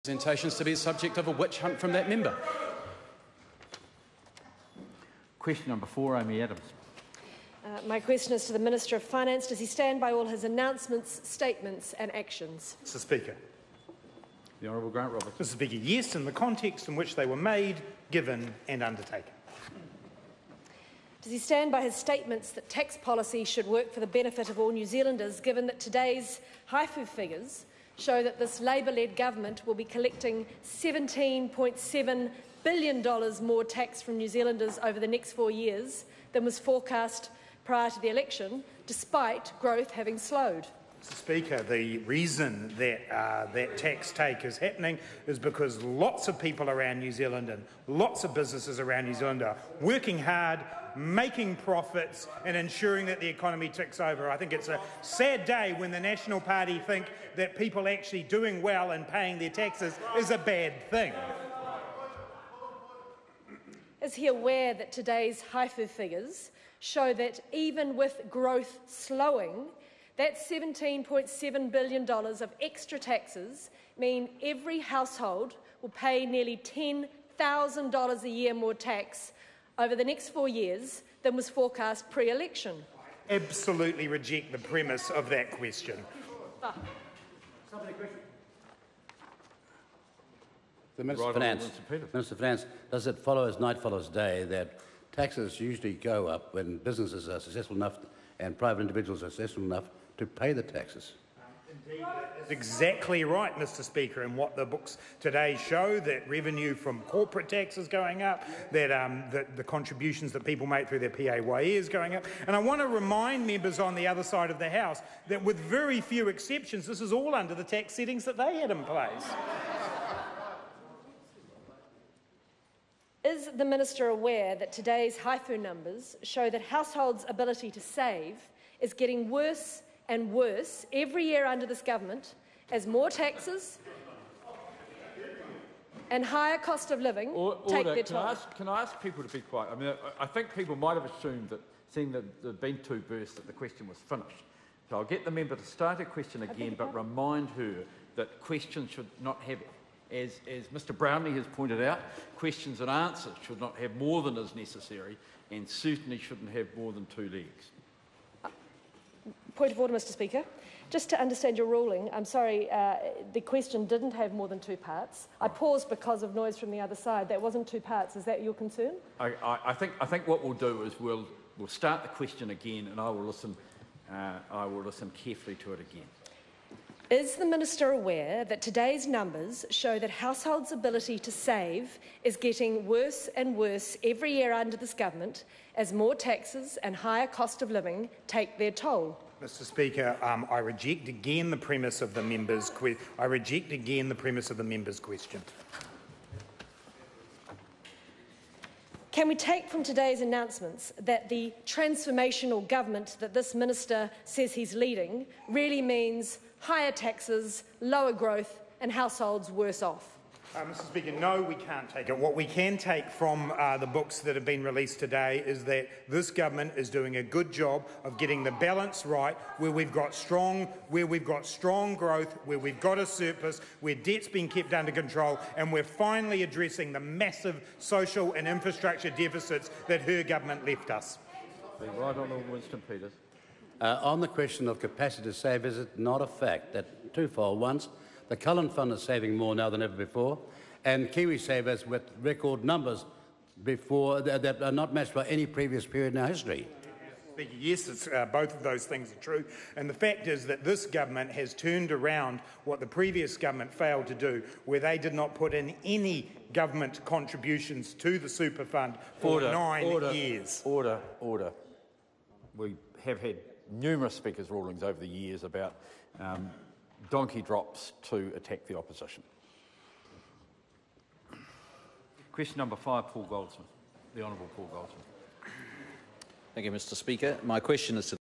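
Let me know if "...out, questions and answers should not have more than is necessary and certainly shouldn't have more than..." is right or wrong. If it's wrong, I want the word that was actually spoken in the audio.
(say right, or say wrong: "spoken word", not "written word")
right.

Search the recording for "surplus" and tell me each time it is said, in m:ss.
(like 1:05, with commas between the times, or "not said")
3:43.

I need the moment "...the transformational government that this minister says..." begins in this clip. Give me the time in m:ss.
3:21.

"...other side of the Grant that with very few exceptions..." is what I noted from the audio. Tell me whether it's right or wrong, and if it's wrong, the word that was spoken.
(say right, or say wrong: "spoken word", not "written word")
wrong: "House", not "Grant".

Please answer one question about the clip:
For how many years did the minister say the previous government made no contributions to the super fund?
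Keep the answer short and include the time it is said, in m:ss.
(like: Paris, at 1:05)
9, at 4:19.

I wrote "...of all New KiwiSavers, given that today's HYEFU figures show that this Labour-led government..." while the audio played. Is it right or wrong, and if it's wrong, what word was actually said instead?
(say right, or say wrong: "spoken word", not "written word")
wrong: "Zealanders", not "KiwiSavers".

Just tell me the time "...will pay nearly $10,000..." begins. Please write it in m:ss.
1:15.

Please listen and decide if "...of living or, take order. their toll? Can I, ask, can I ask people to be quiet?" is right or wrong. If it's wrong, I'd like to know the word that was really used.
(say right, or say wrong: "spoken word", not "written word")
right.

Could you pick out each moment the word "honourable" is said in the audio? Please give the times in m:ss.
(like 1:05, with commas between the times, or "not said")
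0:14, 3:52, 4:34.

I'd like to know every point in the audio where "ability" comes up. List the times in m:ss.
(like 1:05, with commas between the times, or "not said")
2:07, 3:00.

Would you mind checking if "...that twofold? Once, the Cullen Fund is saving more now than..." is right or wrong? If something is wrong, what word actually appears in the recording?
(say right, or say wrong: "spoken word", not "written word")
right.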